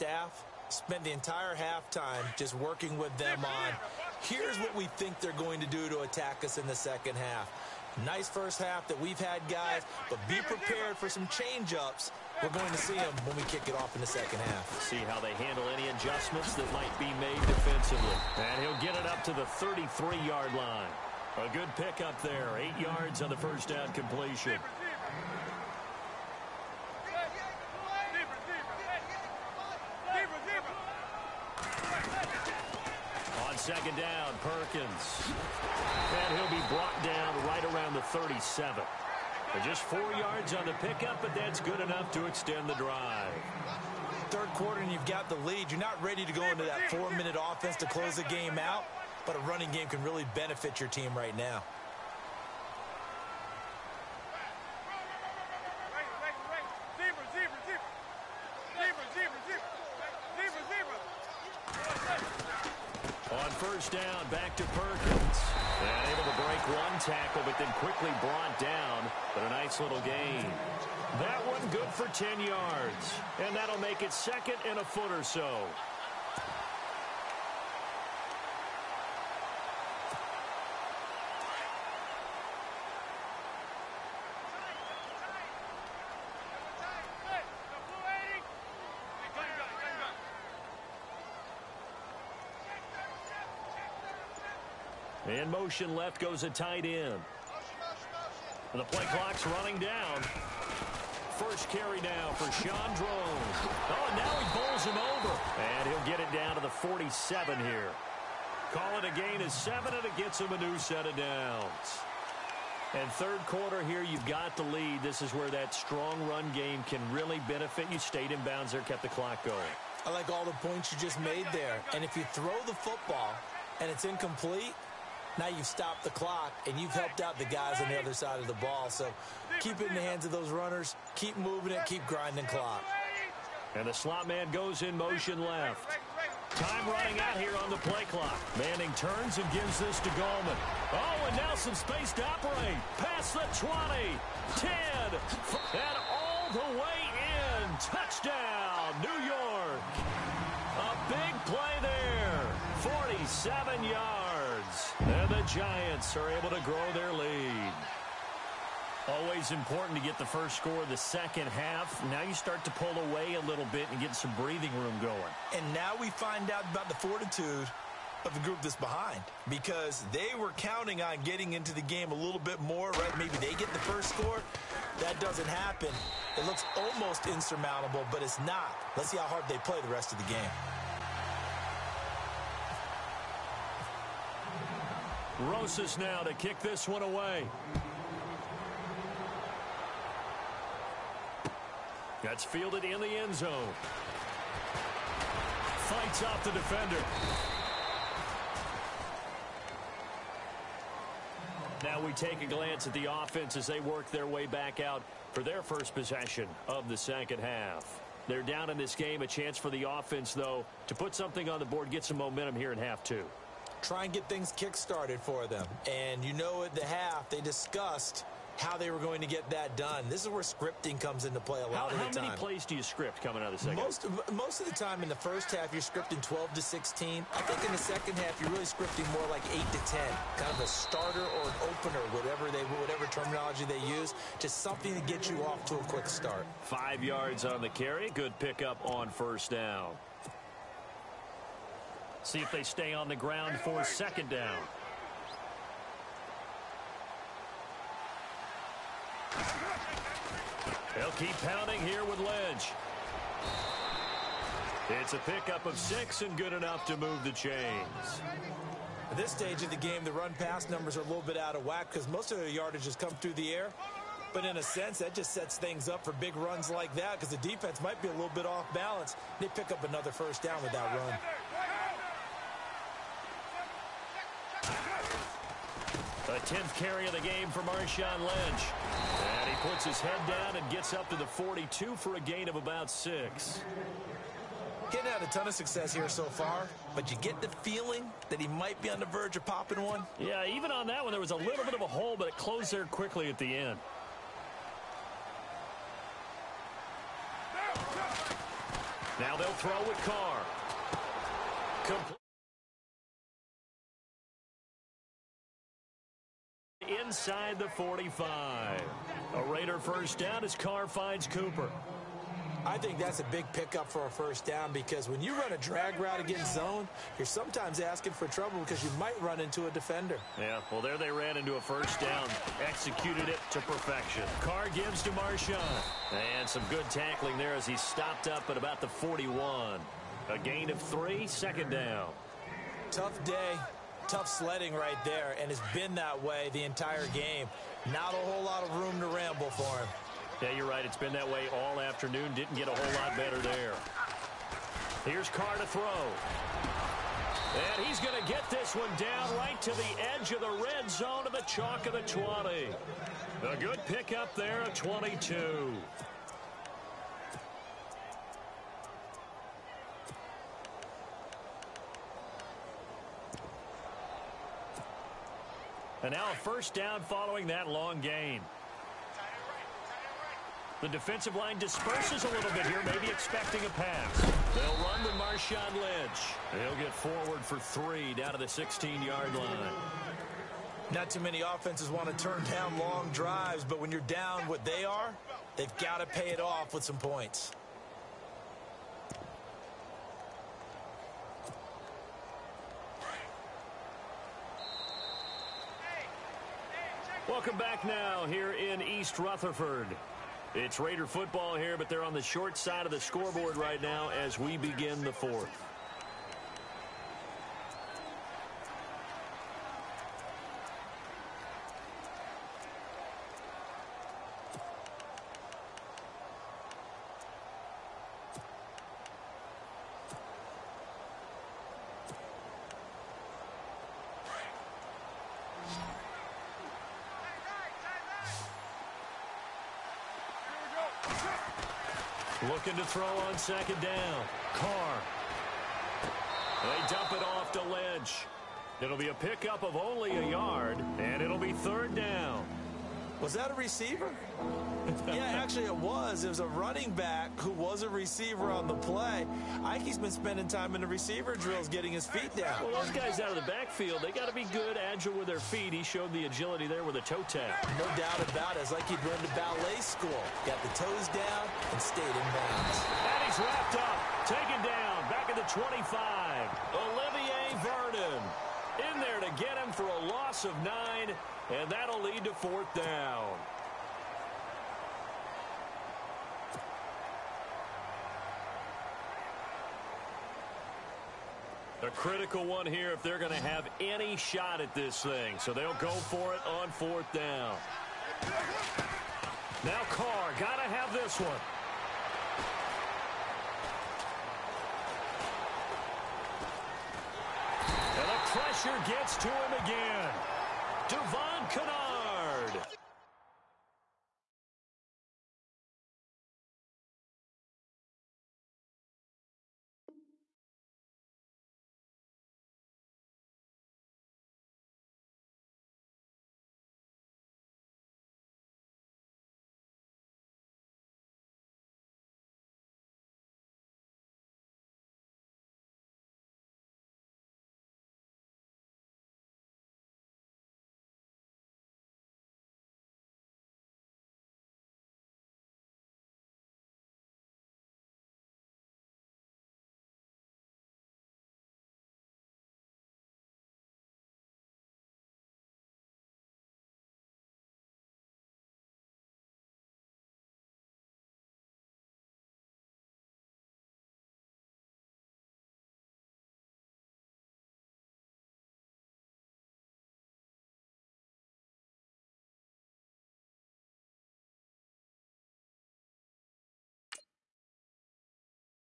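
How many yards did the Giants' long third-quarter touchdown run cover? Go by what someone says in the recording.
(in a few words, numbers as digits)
47.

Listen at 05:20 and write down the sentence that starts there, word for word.
Yeah, well, there they ran into a first down, executed it to perfection.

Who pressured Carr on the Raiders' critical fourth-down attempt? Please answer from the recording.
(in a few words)
Devon Kennard.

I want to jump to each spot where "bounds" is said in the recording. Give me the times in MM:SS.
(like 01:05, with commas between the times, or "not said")
01:58, 07:42.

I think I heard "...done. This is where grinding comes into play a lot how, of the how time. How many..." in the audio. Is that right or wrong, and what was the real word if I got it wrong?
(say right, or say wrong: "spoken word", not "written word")
wrong: "scripting", not "grinding".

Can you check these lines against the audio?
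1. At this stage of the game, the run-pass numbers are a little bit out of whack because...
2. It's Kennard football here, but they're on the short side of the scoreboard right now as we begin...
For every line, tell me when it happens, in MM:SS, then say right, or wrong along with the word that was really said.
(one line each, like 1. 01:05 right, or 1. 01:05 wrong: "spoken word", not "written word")
1. 04:19 right
2. 06:40 wrong: "Raider", not "Kennard".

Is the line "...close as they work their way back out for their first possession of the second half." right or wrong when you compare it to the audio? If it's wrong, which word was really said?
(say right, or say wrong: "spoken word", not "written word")
wrong: "offense", not "close".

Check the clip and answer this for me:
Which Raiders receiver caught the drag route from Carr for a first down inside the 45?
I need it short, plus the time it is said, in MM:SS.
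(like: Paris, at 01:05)
Cooper, at 05:11.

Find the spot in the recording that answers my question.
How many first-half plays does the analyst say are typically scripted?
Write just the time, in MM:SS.
03:46.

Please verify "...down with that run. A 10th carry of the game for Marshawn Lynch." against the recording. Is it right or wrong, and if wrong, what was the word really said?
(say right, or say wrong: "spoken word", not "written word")
right.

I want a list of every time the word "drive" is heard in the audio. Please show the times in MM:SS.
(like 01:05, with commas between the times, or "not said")
00:42, 06:23.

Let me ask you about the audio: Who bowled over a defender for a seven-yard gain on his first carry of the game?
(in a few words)
Sean Drone.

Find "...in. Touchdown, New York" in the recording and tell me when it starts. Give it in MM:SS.
02:27.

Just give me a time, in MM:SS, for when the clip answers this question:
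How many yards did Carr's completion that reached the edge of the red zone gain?
05:54.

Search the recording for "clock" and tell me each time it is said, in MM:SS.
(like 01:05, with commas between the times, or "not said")
01:39, 01:59, 02:06, 02:12, 02:18.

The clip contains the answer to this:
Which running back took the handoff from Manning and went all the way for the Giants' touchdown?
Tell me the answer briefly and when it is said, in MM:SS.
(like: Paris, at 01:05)
Gallman, at 02:20.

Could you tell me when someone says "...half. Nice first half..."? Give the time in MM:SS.
00:07.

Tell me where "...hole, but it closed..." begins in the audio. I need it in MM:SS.
04:51.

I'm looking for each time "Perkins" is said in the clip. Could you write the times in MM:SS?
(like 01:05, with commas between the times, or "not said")
00:34, 01:04.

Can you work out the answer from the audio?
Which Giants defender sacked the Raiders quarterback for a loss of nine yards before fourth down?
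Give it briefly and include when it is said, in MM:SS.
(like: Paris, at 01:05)
Olivier Vernon, at 07:46.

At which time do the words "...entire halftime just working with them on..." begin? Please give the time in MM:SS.
00:01.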